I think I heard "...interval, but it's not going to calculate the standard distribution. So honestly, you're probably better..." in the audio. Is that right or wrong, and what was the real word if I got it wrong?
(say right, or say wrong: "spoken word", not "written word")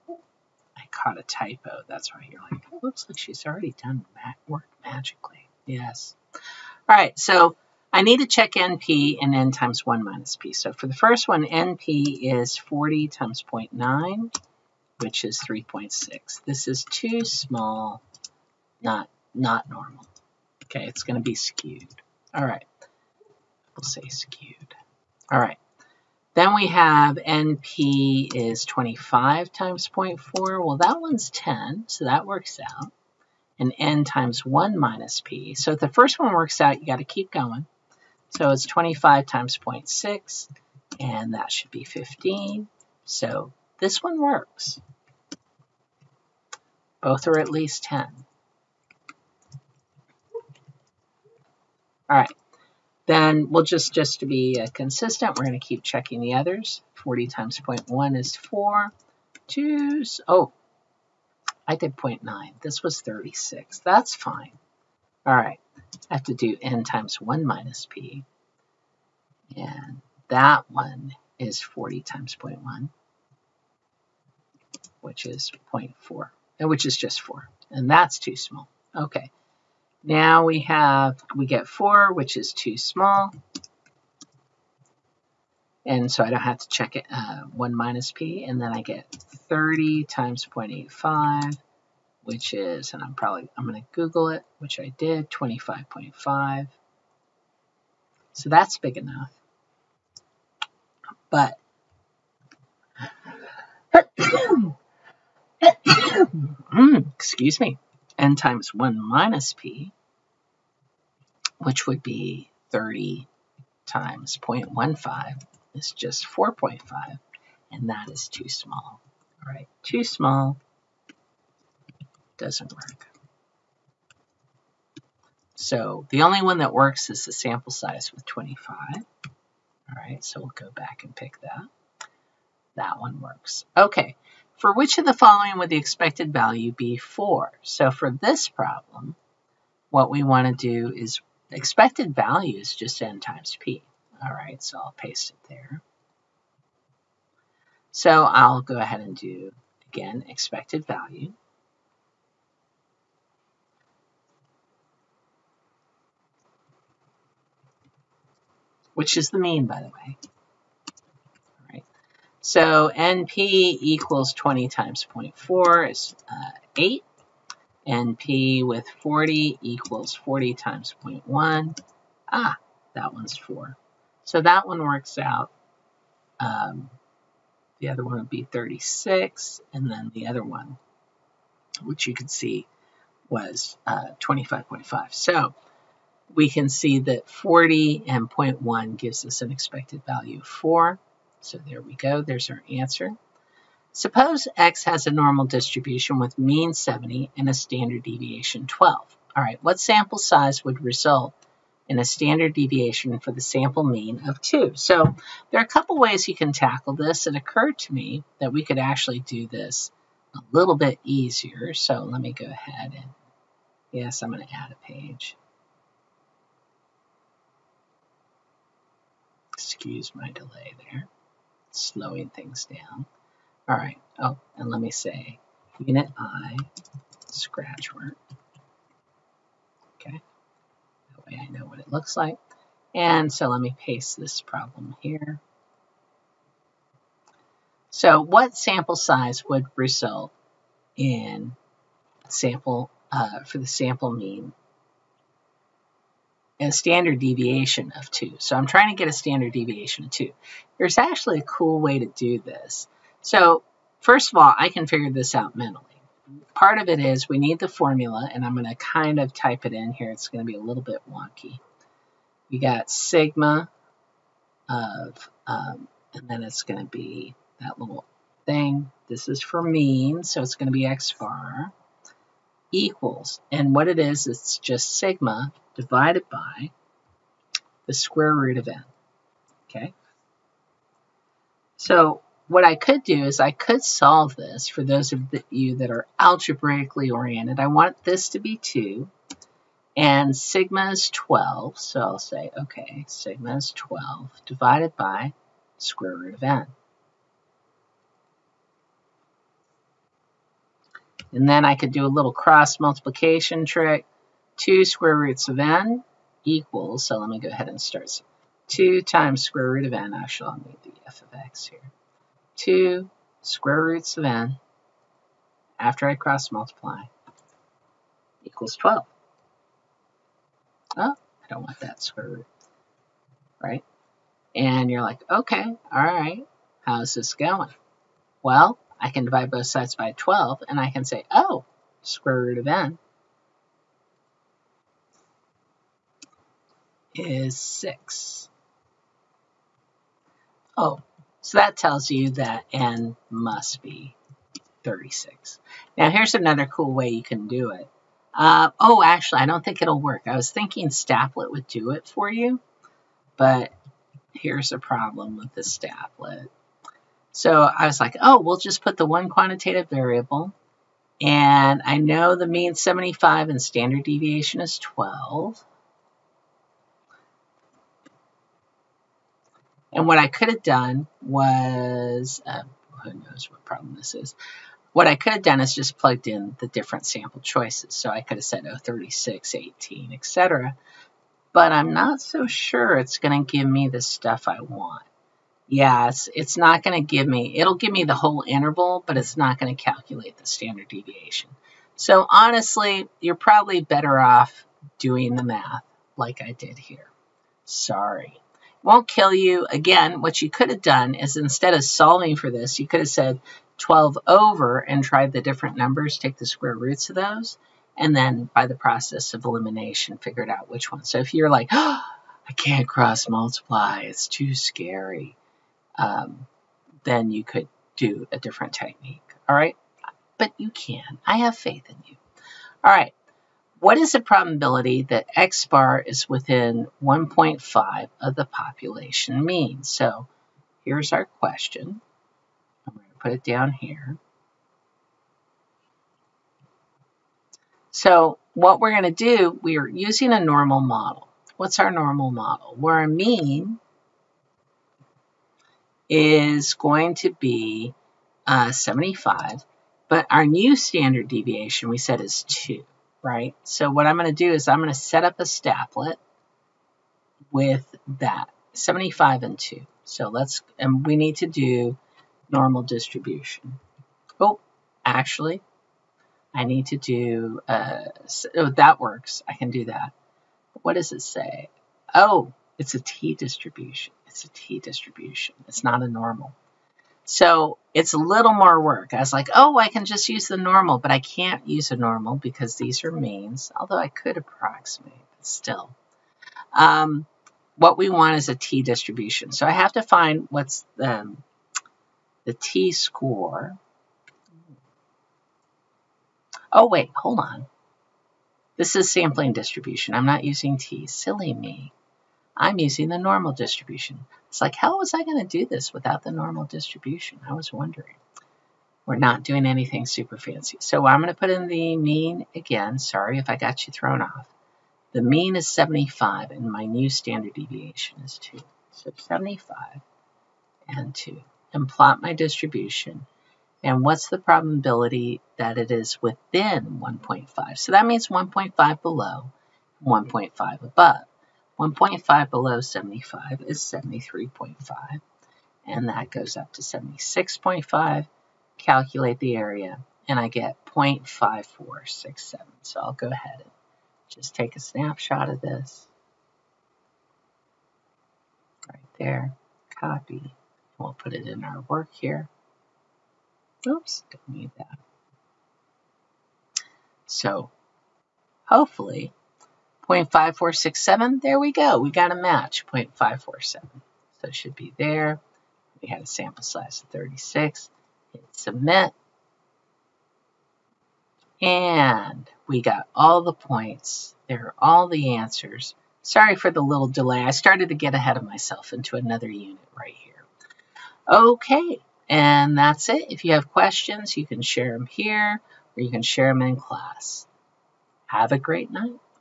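wrong: "deviation", not "distribution".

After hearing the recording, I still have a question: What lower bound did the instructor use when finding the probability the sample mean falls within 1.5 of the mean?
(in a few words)
73.5.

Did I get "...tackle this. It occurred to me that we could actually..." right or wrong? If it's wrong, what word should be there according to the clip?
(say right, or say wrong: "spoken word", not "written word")
right.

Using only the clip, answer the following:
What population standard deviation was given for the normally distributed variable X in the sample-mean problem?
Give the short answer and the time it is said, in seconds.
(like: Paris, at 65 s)
12, at 197 s.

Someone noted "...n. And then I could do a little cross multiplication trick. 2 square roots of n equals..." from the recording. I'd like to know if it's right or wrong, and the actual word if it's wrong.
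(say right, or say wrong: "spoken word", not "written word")
right.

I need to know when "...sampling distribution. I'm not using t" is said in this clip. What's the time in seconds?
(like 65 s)
499 s.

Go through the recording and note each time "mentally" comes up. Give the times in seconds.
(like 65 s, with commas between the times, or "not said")
255 s.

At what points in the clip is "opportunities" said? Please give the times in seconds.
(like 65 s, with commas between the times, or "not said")
not said.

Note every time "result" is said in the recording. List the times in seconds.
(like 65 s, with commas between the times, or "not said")
200 s, 239 s.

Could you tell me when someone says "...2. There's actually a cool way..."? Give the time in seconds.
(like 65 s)
250 s.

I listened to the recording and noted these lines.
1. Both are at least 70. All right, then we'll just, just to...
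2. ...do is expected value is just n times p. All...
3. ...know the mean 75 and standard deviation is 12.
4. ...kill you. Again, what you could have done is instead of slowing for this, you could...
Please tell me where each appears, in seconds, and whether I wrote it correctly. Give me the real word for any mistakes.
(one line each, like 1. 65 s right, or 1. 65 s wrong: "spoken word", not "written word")
1. 47 s wrong: "10", not "70"
2. 140 s right
3. 361 s right
4. 399 s wrong: "solving", not "slowing".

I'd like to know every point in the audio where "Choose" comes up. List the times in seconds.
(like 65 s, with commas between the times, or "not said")
59 s.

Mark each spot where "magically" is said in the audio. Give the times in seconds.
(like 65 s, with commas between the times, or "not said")
4 s.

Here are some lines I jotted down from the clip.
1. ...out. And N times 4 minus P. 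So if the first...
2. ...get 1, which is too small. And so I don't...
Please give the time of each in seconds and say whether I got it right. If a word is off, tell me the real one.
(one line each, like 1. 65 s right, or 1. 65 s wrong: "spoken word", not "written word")
1. 32 s wrong: "1", not "4"
2. 81 s wrong: "4", not "1".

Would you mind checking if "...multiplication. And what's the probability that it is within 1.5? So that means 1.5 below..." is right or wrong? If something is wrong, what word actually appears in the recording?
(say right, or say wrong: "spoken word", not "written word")
wrong: "distribution", not "multiplication".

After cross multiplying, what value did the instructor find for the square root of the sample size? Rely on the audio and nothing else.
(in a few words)
6.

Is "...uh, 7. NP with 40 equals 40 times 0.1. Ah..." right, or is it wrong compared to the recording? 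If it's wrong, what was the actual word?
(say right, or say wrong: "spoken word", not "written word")
wrong: "8", not "7".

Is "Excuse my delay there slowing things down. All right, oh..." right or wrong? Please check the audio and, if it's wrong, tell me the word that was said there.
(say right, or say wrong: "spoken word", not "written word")
right.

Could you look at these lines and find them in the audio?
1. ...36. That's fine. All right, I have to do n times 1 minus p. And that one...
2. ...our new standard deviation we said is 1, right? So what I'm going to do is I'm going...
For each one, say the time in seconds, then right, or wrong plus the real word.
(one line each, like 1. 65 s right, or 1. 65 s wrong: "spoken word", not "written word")
1. 63 s right
2. 450 s wrong: "2", not "1".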